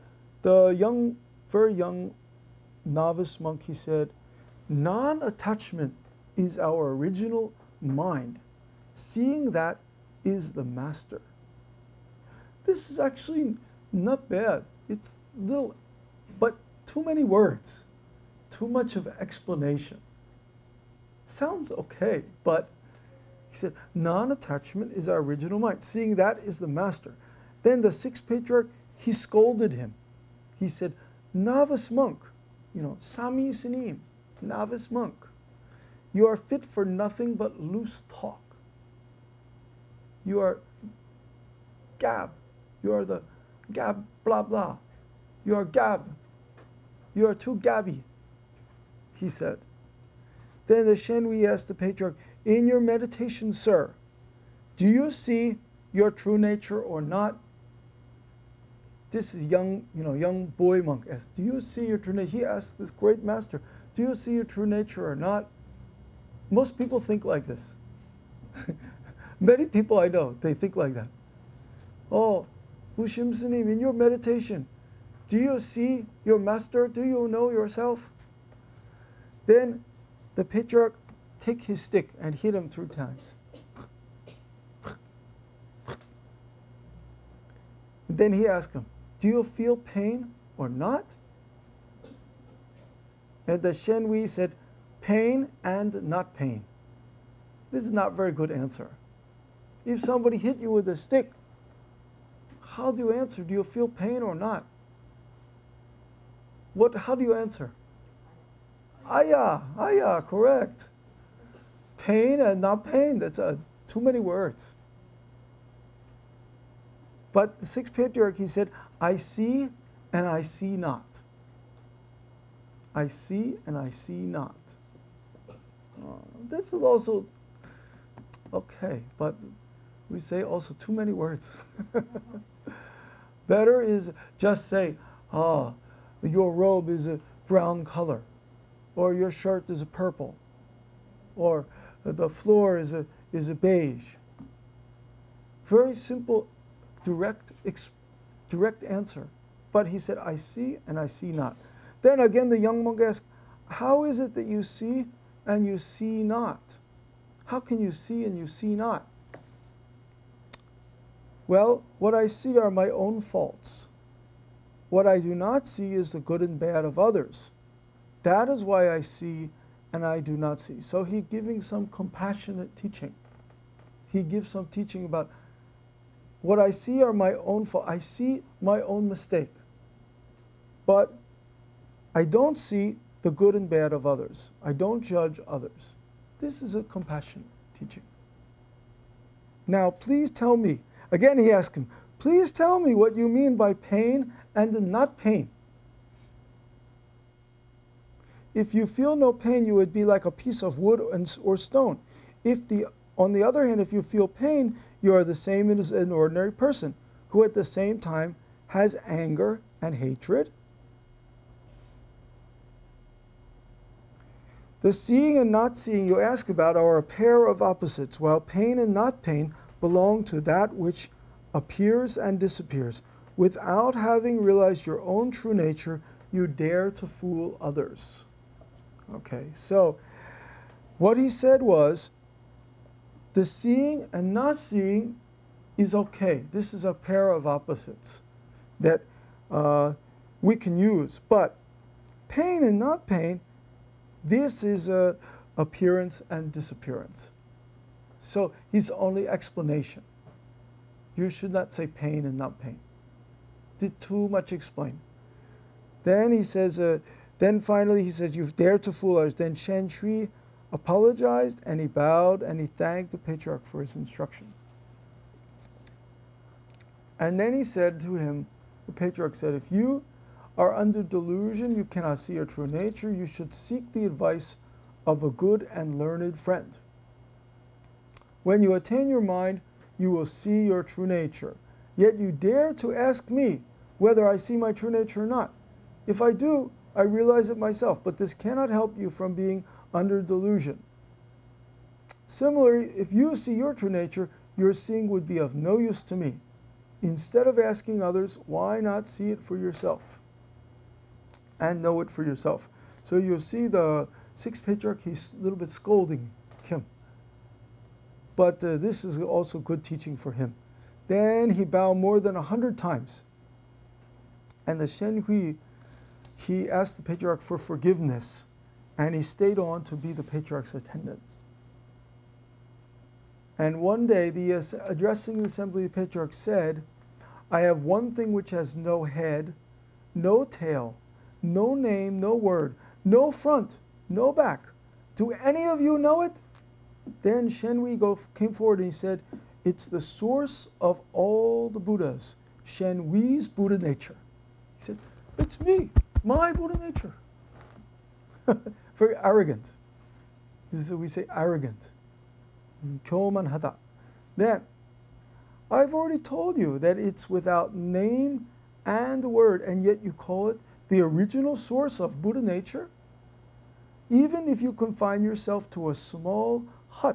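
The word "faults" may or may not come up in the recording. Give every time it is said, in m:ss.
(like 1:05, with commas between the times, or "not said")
2:43, 2:57.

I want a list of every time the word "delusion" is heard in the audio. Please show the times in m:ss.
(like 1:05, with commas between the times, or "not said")
4:31, 4:50.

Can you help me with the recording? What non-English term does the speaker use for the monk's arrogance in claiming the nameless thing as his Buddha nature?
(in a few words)
Kyomanhata.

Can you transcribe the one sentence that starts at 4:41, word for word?
Yet you dare to ask me whether I see my true nature or not.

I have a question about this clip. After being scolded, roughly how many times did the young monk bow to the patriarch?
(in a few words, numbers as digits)
More than 100.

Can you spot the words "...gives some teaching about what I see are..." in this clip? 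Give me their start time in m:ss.
2:54.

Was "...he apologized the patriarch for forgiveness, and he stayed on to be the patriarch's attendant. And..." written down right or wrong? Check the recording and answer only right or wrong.
wrong.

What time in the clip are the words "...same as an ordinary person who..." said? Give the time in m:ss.
3:25.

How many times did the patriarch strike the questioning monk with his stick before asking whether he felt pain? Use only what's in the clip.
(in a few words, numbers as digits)
3.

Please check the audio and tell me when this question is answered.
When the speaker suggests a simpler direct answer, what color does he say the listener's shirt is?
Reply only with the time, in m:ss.
2:19.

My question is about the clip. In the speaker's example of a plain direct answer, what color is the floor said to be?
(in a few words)
Beige.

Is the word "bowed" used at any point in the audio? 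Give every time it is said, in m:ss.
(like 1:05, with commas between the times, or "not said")
4:21, 5:11.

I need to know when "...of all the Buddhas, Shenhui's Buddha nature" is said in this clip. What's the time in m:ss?
5:40.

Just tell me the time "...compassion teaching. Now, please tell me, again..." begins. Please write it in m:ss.
3:06.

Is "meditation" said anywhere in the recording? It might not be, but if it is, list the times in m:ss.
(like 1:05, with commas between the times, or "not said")
0:52, 1:13.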